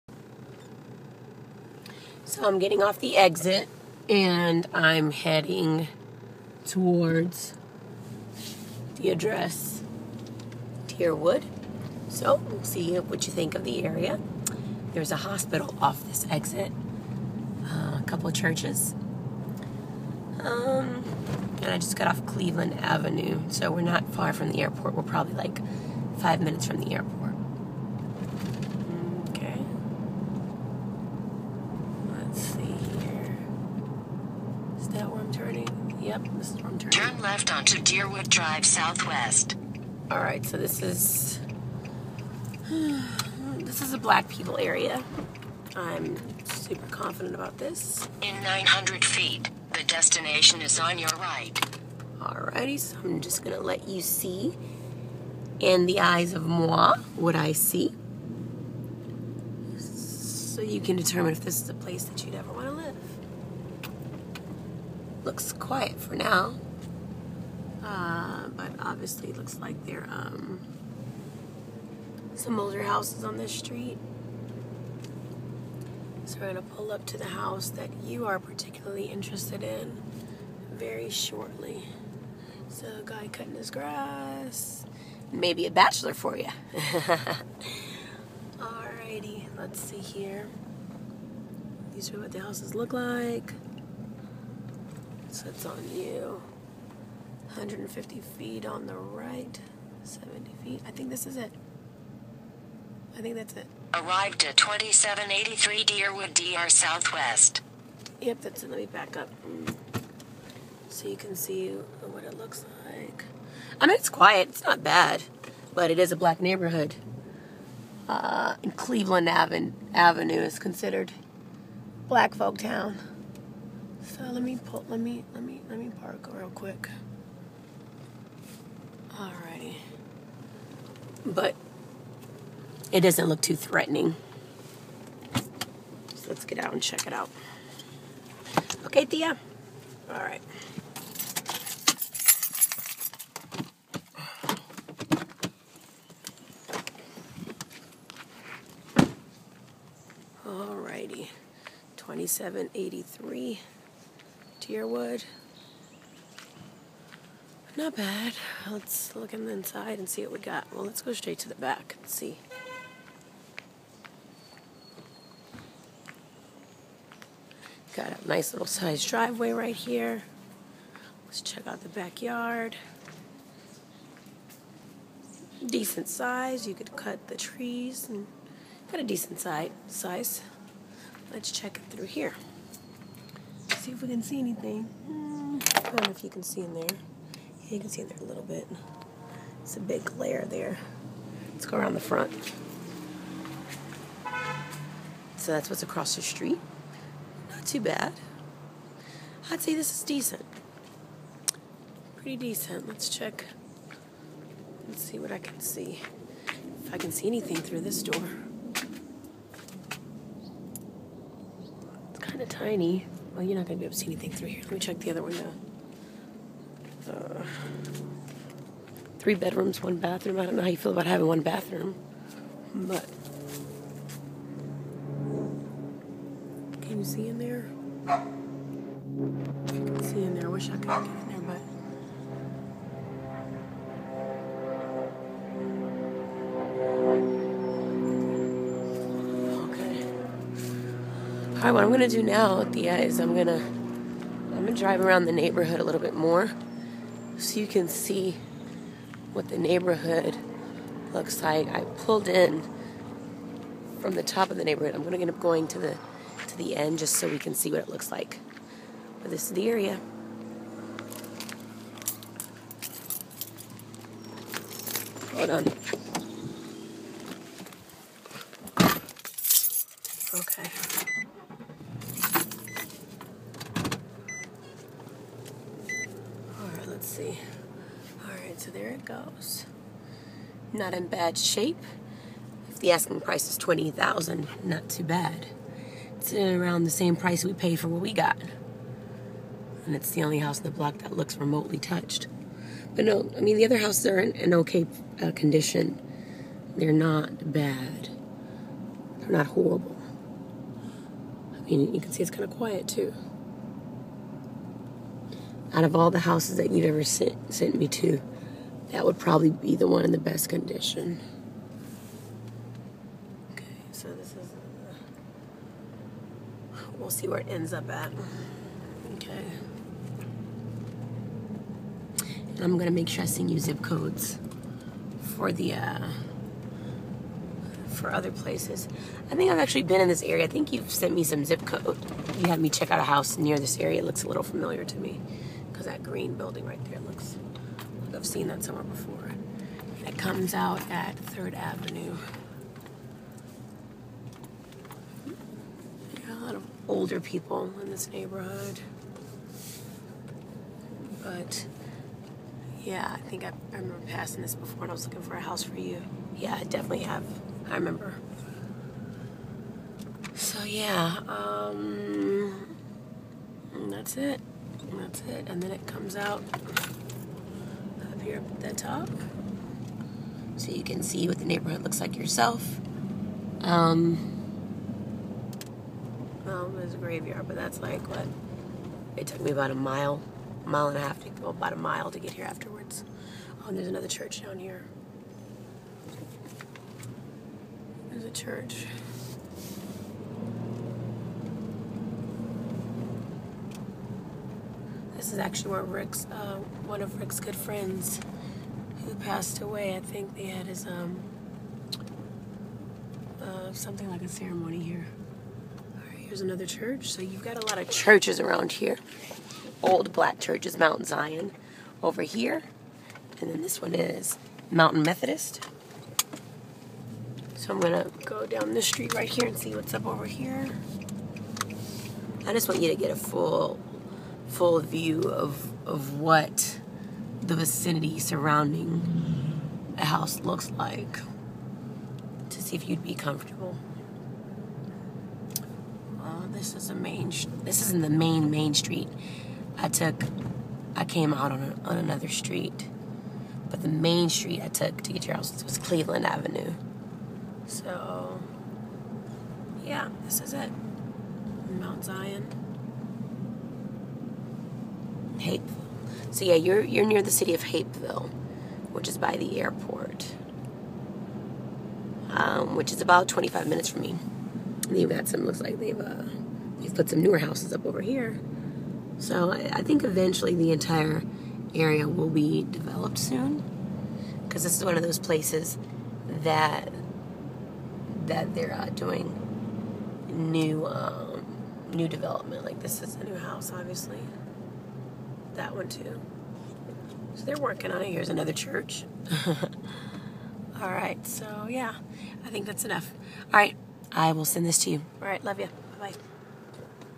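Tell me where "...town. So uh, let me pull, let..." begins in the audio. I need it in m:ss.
2:02.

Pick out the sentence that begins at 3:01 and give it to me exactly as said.
Let's check it through here see if we can see anything.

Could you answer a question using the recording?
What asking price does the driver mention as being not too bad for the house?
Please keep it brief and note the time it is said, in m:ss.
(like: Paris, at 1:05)
20000, at 4:43.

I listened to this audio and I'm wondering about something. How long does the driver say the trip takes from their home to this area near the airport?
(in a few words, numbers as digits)
25 minutes.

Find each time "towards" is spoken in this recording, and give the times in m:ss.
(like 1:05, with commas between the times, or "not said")
0:06.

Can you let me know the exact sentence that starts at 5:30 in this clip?
I think you've sent me some zip code.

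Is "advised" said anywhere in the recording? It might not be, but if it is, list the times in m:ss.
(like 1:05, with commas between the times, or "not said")
not said.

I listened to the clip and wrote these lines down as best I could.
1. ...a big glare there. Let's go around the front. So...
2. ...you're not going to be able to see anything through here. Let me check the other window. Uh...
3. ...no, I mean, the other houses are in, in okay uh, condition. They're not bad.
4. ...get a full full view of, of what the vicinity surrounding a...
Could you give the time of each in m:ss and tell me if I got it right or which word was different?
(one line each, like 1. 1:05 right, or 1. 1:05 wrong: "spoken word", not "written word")
1. 3:09 right
2. 3:33 right
3. 4:53 right
4. 7:02 right.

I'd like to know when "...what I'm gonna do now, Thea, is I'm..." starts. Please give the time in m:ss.
4:01.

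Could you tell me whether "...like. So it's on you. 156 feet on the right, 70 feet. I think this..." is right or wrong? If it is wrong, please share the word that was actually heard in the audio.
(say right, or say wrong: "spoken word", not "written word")
wrong: "150", not "156".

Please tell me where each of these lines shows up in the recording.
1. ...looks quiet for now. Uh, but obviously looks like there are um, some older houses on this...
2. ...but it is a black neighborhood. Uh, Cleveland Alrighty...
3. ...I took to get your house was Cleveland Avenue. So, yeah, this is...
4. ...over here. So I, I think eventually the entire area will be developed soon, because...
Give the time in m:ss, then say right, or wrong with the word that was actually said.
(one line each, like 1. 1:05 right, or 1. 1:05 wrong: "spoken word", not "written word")
1. 1:05 right
2. 1:55 wrong: "Avenue", not "Alrighty"
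3. 7:24 right
4. 7:47 right.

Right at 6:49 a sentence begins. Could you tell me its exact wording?
Old black churches, Mount Zion over here.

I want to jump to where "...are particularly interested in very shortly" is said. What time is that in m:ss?
1:18.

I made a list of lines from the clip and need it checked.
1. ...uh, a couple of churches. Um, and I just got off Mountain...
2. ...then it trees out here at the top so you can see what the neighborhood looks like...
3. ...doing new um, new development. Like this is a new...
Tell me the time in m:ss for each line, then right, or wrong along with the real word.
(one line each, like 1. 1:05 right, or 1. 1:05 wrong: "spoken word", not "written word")
1. 0:17 wrong: "Cleveland", not "Mountain"
2. 6:05 wrong: "comes", not "trees"
3. 7:58 right.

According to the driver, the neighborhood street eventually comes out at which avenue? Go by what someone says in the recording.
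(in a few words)
3rd Avenue.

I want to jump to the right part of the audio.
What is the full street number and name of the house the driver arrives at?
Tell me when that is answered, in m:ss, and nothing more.
1:44.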